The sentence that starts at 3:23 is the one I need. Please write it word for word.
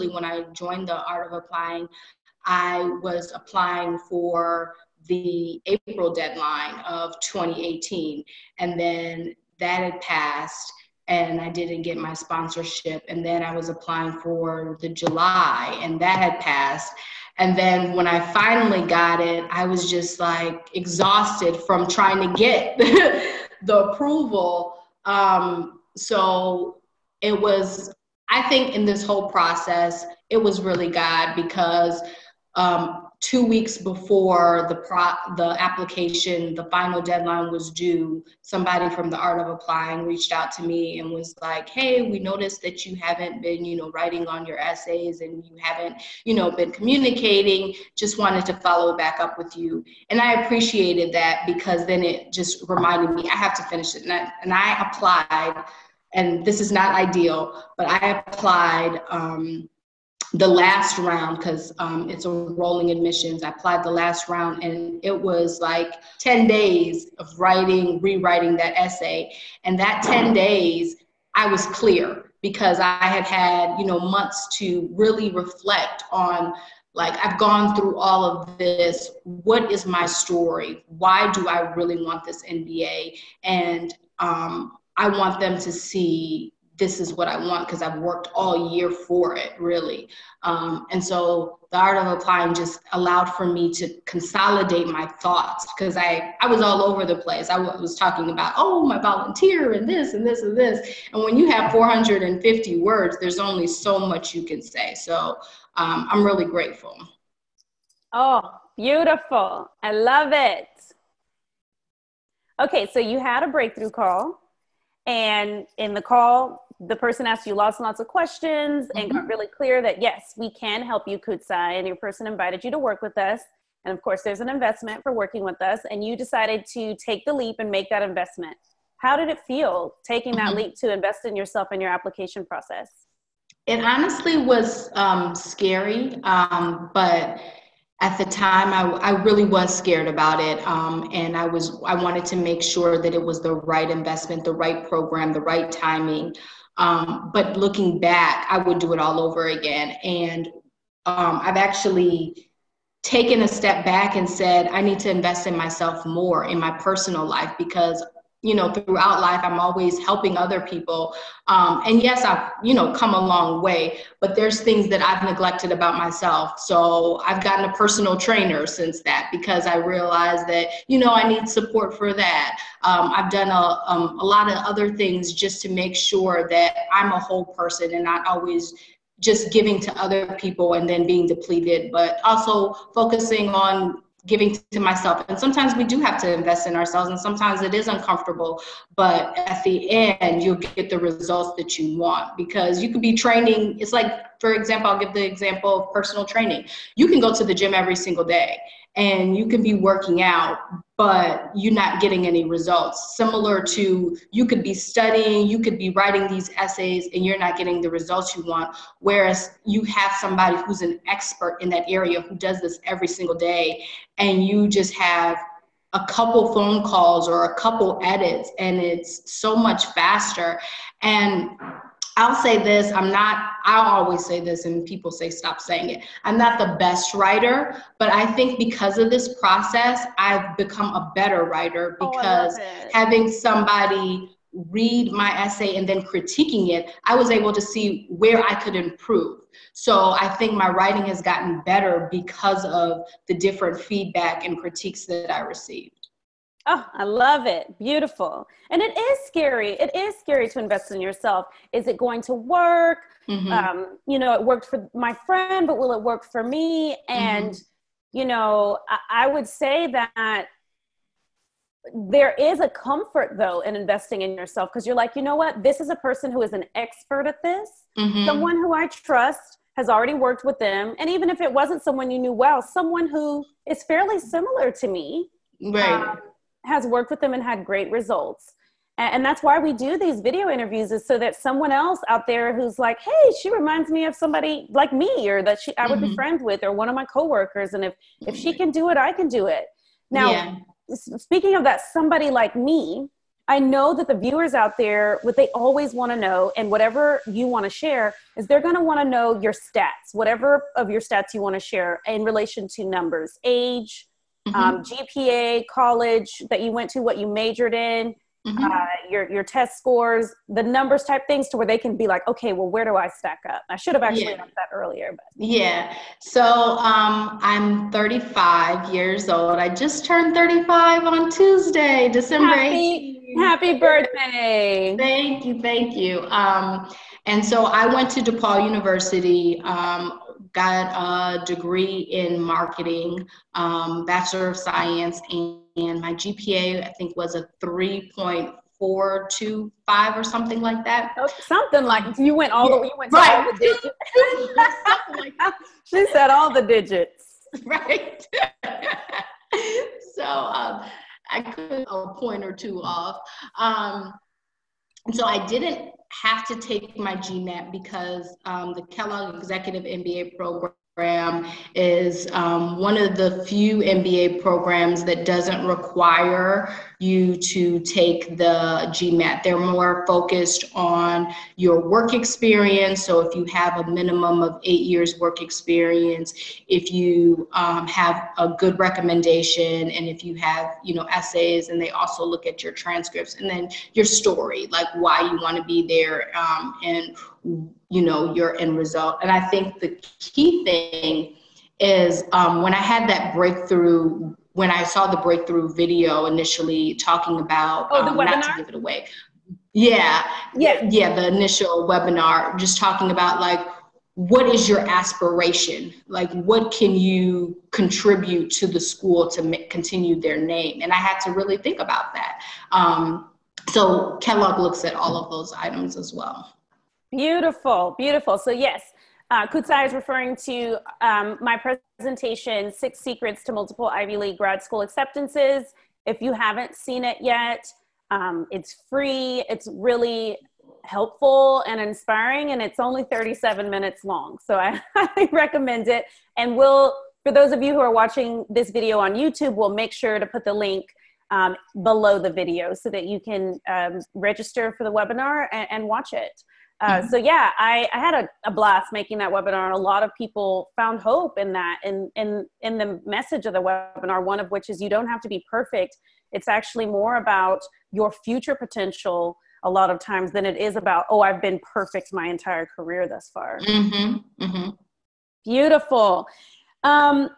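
Similar to you could be studying, you could be writing these essays, and you're not getting the results you want.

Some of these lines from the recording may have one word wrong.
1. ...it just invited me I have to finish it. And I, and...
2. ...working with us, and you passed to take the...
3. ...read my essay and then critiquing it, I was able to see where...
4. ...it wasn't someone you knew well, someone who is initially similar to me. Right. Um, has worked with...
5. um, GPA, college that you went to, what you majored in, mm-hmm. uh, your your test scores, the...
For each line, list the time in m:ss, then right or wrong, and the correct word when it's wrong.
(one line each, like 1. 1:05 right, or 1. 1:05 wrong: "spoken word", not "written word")
1. 0:52 wrong: "reminded", not "invited"
2. 2:05 wrong: "decided", not "passed"
3. 3:54 right
4. 4:31 wrong: "fairly", not "initially"
5. 5:04 right.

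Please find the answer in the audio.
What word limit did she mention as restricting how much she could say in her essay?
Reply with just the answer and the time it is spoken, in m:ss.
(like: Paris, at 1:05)
450 words, at 1:41.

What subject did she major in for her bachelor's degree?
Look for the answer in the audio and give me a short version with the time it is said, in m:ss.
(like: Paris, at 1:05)
marketing, at 5:32.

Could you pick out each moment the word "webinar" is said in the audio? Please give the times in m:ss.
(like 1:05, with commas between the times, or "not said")
6:41, 7:24, 7:29, 7:33.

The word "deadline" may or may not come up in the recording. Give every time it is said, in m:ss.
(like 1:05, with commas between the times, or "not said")
0:06, 0:37.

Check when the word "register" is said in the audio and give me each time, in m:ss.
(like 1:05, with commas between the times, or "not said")
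7:24.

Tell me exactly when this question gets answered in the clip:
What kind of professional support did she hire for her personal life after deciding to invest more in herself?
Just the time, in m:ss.
2:47.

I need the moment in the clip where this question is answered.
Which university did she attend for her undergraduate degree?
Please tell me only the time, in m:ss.
5:28.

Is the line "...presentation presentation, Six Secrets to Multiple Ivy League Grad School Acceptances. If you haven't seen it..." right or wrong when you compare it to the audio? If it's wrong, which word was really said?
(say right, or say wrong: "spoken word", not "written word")
right.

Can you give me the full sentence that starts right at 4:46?
be friends with or one of my coworkers.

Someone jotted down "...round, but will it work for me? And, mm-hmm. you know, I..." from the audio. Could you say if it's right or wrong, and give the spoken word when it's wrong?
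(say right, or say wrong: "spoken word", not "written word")
wrong: "friend", not "round".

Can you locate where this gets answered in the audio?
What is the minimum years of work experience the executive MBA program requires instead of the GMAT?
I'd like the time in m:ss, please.
6:14.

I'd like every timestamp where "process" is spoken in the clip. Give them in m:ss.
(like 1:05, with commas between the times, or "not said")
0:29, 2:12, 3:49.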